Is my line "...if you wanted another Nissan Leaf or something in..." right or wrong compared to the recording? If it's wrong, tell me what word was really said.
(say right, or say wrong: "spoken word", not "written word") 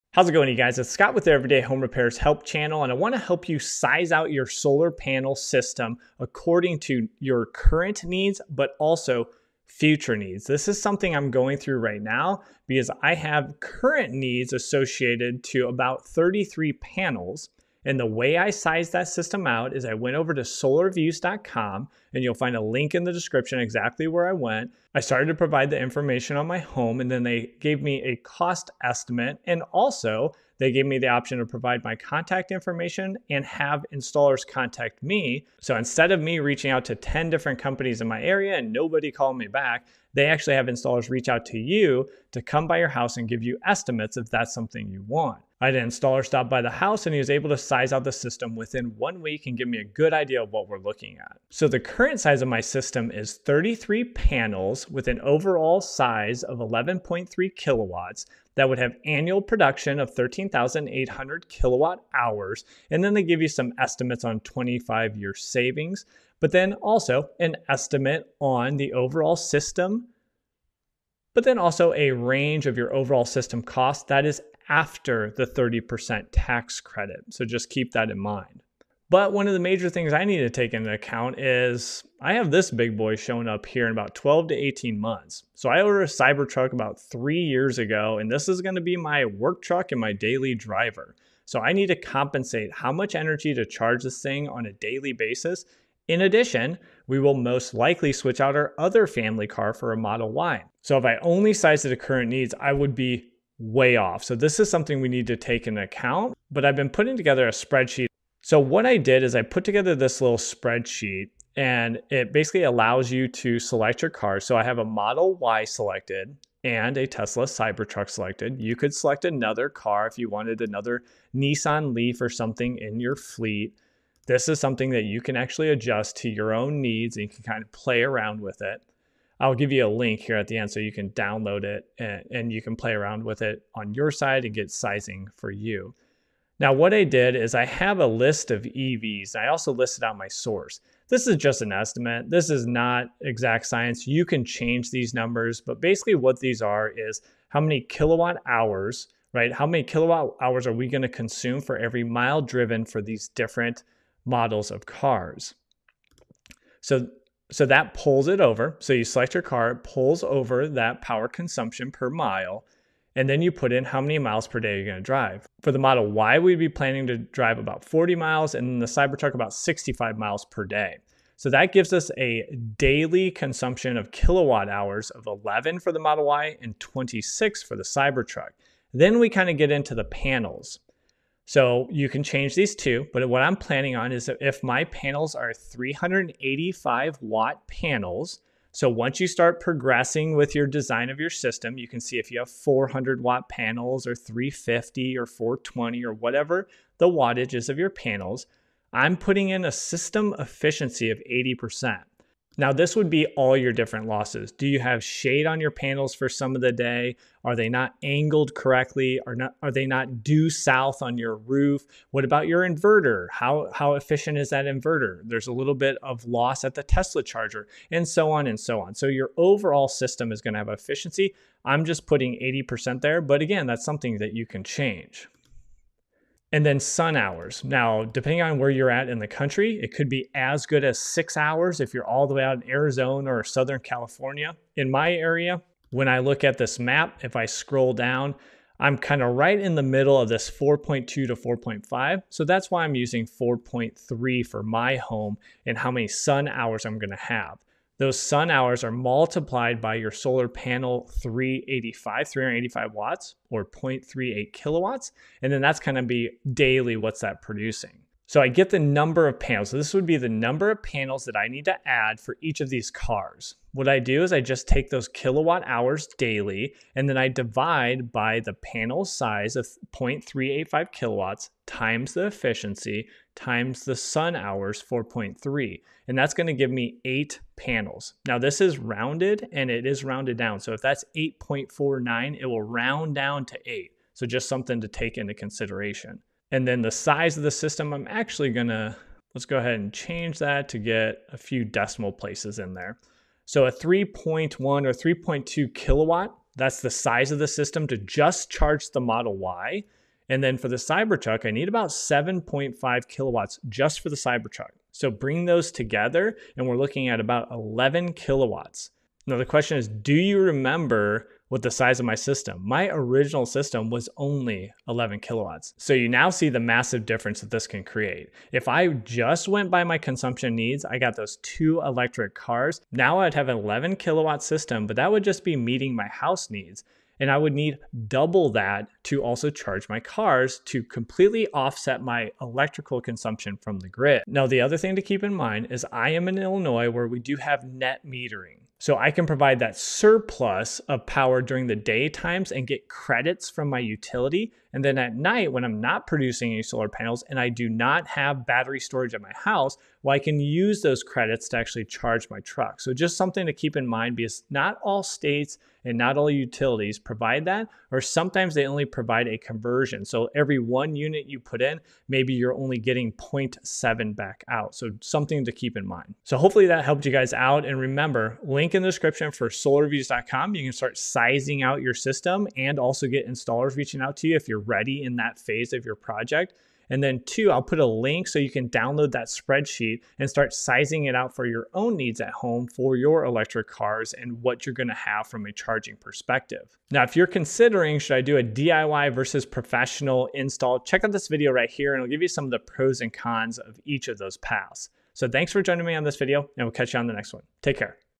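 right.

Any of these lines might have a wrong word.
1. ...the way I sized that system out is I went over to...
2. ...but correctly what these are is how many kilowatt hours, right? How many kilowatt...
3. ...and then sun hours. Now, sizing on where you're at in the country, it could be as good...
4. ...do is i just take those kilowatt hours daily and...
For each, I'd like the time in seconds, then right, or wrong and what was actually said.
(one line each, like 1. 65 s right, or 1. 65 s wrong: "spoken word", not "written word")
1. 17 s right
2. 145 s wrong: "basically", not "correctly"
3. 226 s wrong: "depending", not "sizing"
4. 263 s right.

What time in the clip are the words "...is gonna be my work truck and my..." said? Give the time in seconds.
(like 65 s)
88 s.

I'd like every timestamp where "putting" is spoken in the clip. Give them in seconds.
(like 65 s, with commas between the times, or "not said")
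106 s, 199 s, 222 s.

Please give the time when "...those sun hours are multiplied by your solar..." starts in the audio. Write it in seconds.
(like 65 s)
248 s.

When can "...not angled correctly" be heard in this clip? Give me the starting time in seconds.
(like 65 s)
207 s.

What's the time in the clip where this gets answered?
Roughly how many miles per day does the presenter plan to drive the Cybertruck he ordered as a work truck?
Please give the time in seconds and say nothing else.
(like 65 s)
169 s.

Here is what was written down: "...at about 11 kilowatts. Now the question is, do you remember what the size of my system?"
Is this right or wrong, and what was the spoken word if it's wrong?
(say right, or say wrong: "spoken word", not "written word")
right.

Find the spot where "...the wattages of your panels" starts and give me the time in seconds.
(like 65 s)
196 s.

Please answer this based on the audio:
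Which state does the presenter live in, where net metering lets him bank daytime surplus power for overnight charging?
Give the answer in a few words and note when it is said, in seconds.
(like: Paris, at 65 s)
Illinois, at 336 s.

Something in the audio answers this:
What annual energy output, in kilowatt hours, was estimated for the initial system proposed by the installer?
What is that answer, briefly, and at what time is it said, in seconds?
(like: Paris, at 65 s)
13,800, at 60 s.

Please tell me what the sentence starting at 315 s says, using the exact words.
So you now see the massive difference that this can create.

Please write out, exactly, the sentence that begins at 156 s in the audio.
So so that pulls it over.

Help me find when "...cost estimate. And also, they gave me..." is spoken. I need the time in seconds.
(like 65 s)
28 s.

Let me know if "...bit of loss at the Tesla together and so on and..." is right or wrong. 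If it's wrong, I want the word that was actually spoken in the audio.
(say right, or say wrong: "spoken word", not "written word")
wrong: "charger", not "together".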